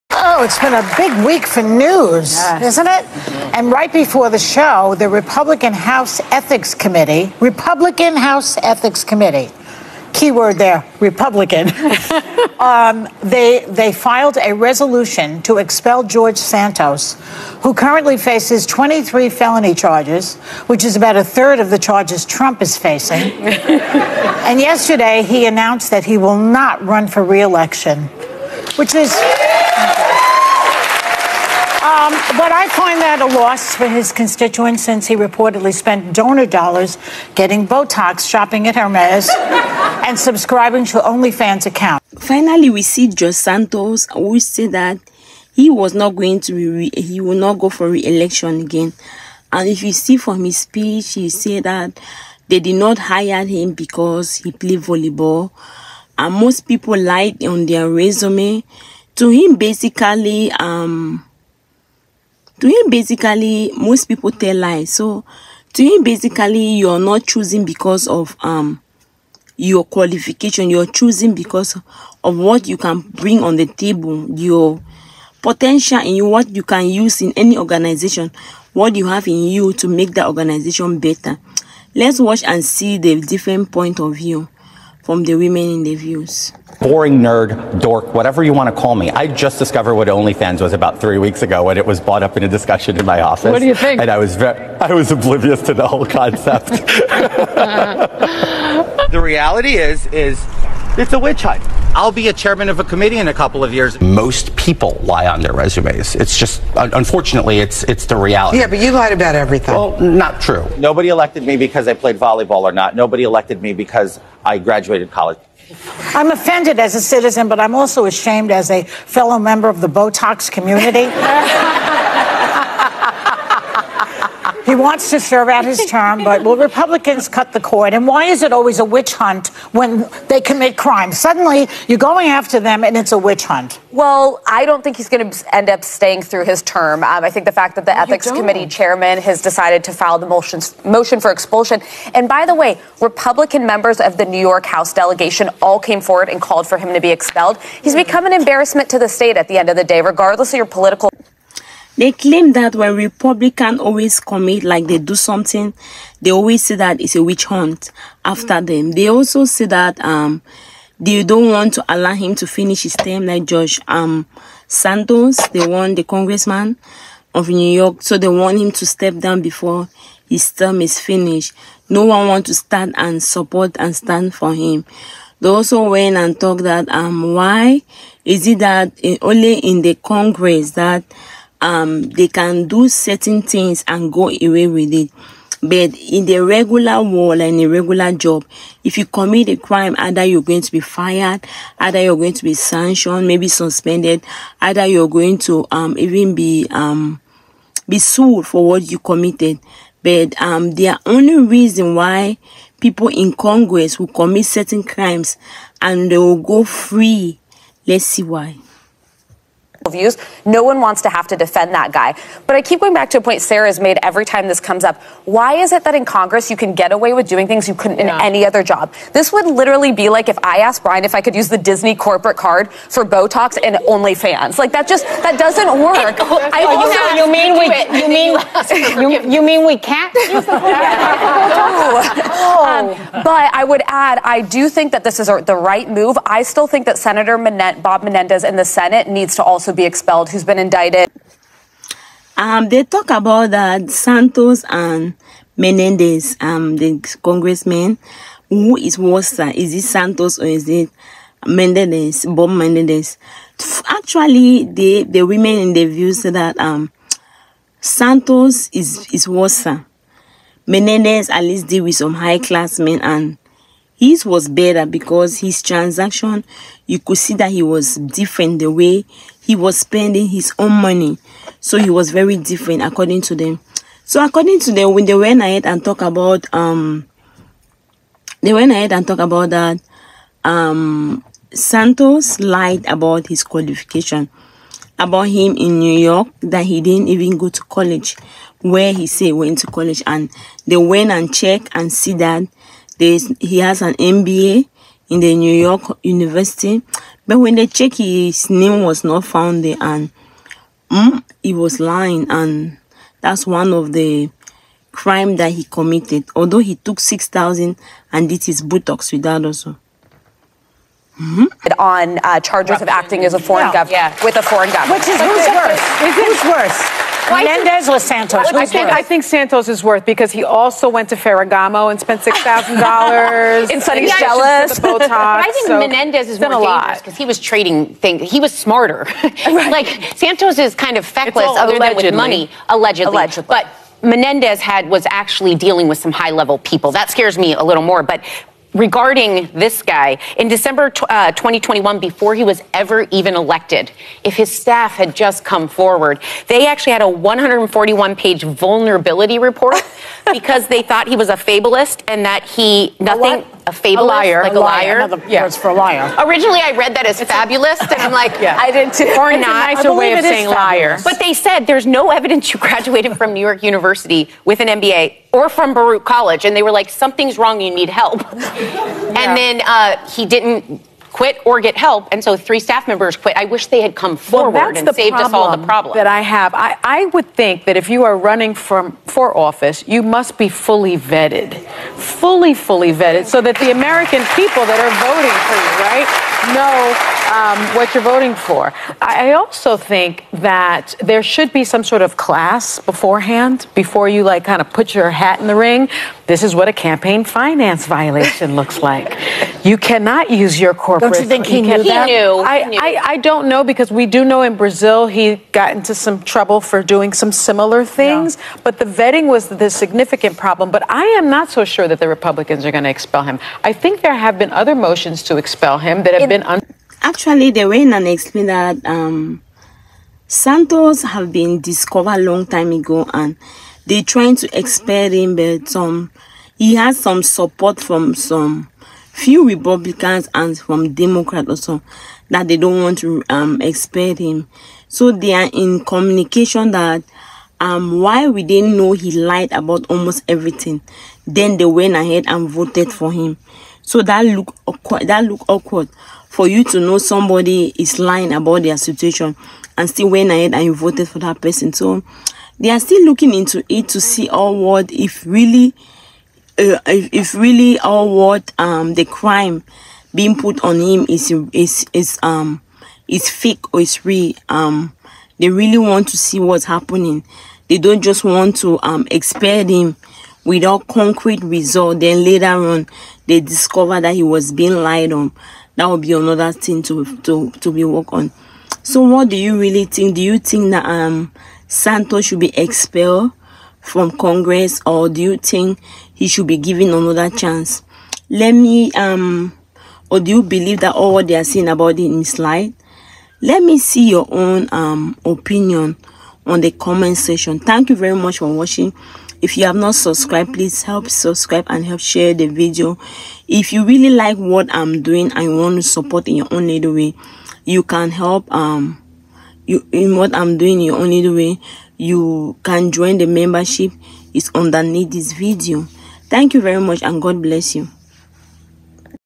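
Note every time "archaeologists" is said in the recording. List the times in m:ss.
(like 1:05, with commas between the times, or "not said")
not said.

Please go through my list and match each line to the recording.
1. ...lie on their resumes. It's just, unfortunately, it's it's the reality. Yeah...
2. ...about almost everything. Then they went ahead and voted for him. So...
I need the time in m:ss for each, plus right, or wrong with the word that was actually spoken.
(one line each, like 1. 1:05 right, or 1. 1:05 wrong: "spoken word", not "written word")
1. 1:45 right
2. 7:19 right.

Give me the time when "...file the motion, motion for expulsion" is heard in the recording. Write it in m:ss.
2:19.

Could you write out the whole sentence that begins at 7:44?
Um they really want to see what's happening.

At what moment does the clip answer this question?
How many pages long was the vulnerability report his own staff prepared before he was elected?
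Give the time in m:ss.
5:47.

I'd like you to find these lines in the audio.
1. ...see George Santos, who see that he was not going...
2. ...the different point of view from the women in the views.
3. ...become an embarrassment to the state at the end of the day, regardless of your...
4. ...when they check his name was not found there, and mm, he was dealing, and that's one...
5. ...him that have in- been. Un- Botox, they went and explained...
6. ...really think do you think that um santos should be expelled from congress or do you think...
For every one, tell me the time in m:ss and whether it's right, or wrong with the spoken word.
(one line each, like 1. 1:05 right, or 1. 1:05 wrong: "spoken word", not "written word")
1. 0:42 right
2. 1:22 right
3. 2:27 right
4. 4:57 wrong: "lying", not "dealing"
5. 6:55 wrong: "Actually", not "Botox"
6. 7:59 right.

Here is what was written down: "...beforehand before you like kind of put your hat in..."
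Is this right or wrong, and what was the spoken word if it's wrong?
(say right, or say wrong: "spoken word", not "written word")
right.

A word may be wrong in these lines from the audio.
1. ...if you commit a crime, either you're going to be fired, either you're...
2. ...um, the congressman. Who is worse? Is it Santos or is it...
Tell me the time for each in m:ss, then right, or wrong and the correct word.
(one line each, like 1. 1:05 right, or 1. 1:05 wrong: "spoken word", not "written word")
1. 3:08 right
2. 4:06 right.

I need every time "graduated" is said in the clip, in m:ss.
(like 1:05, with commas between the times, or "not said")
1:54, 6:02.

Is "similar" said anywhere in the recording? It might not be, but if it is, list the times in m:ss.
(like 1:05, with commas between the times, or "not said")
6:47.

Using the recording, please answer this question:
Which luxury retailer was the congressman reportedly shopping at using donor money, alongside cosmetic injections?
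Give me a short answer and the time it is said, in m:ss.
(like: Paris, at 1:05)
Hermes, at 0:38.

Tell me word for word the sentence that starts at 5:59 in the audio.
A nicer way of saying liar.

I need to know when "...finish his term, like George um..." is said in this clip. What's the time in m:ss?
2:42.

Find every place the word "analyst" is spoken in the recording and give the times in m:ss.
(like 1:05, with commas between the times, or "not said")
not said.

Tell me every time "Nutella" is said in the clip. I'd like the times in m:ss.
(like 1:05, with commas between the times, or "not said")
not said.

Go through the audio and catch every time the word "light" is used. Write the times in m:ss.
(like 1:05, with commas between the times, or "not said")
8:12.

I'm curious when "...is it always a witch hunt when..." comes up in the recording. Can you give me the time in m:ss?
2:08.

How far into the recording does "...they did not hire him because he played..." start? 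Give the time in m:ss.
0:52.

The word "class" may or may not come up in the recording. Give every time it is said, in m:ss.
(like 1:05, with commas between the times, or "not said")
4:22, 6:32.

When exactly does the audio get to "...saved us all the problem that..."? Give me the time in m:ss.
6:14.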